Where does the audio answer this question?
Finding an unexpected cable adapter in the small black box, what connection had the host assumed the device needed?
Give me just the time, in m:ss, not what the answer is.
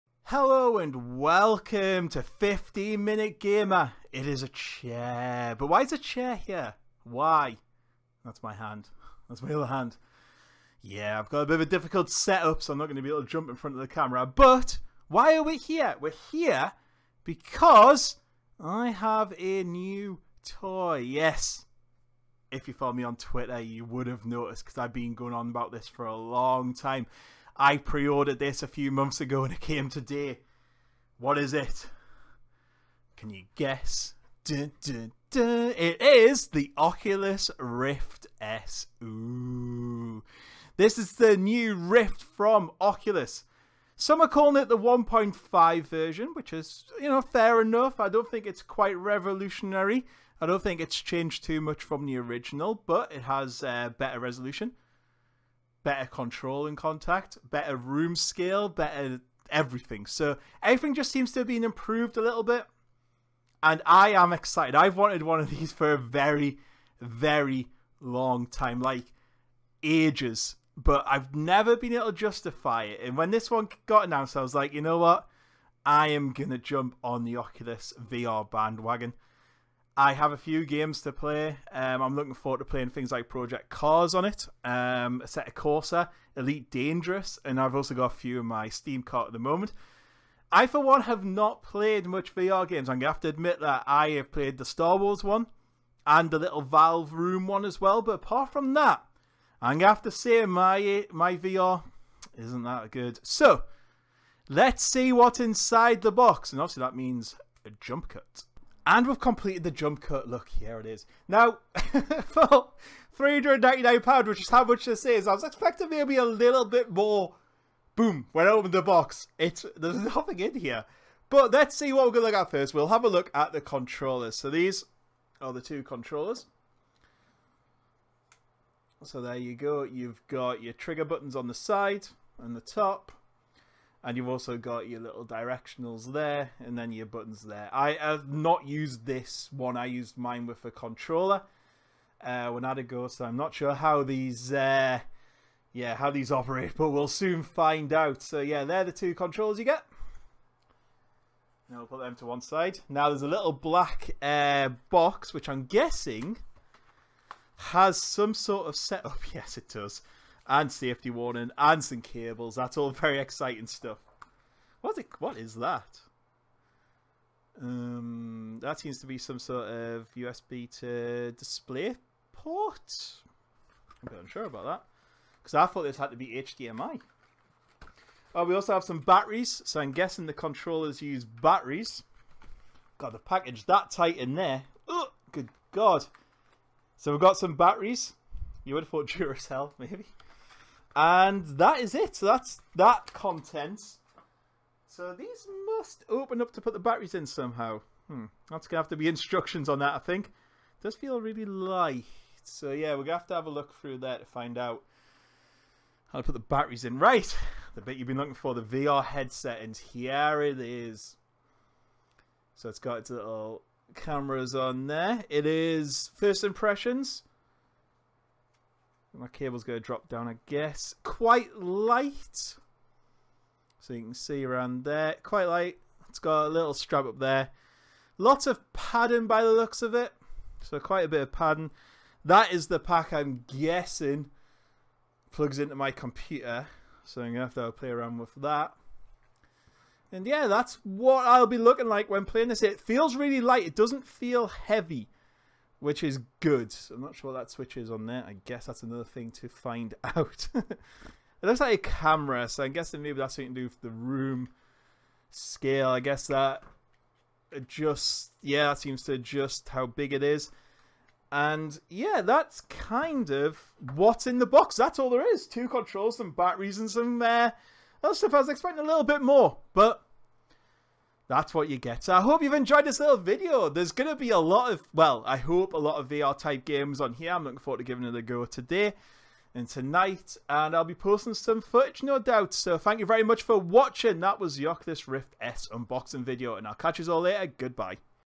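2:56.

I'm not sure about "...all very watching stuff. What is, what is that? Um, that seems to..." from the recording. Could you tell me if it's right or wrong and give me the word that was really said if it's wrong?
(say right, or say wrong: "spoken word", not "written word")
wrong: "exciting", not "watching".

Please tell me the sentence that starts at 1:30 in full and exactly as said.
I, for one, have not played much VR games.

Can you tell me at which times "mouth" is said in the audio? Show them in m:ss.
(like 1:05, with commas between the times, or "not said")
not said.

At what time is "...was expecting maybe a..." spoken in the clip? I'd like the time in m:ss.
1:55.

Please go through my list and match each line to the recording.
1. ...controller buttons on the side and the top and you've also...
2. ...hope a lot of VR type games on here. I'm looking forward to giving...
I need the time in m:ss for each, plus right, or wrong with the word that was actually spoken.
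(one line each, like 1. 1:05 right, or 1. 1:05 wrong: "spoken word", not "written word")
1. 2:10 wrong: "trigger", not "controller"
2. 4:35 right.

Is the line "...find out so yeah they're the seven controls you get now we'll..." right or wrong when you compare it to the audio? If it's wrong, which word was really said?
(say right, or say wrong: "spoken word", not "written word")
wrong: "two", not "seven".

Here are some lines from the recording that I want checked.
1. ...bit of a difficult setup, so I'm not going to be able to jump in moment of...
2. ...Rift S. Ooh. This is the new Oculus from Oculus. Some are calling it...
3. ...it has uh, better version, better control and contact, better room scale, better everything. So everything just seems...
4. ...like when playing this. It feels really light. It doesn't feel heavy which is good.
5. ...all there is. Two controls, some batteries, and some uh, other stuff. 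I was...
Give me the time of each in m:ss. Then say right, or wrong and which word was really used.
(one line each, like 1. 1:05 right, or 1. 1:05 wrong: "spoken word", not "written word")
1. 0:11 wrong: "front", not "moment"
2. 0:37 wrong: "Rift", not "Oculus"
3. 0:53 wrong: "resolution", not "version"
4. 4:01 right
5. 4:24 right.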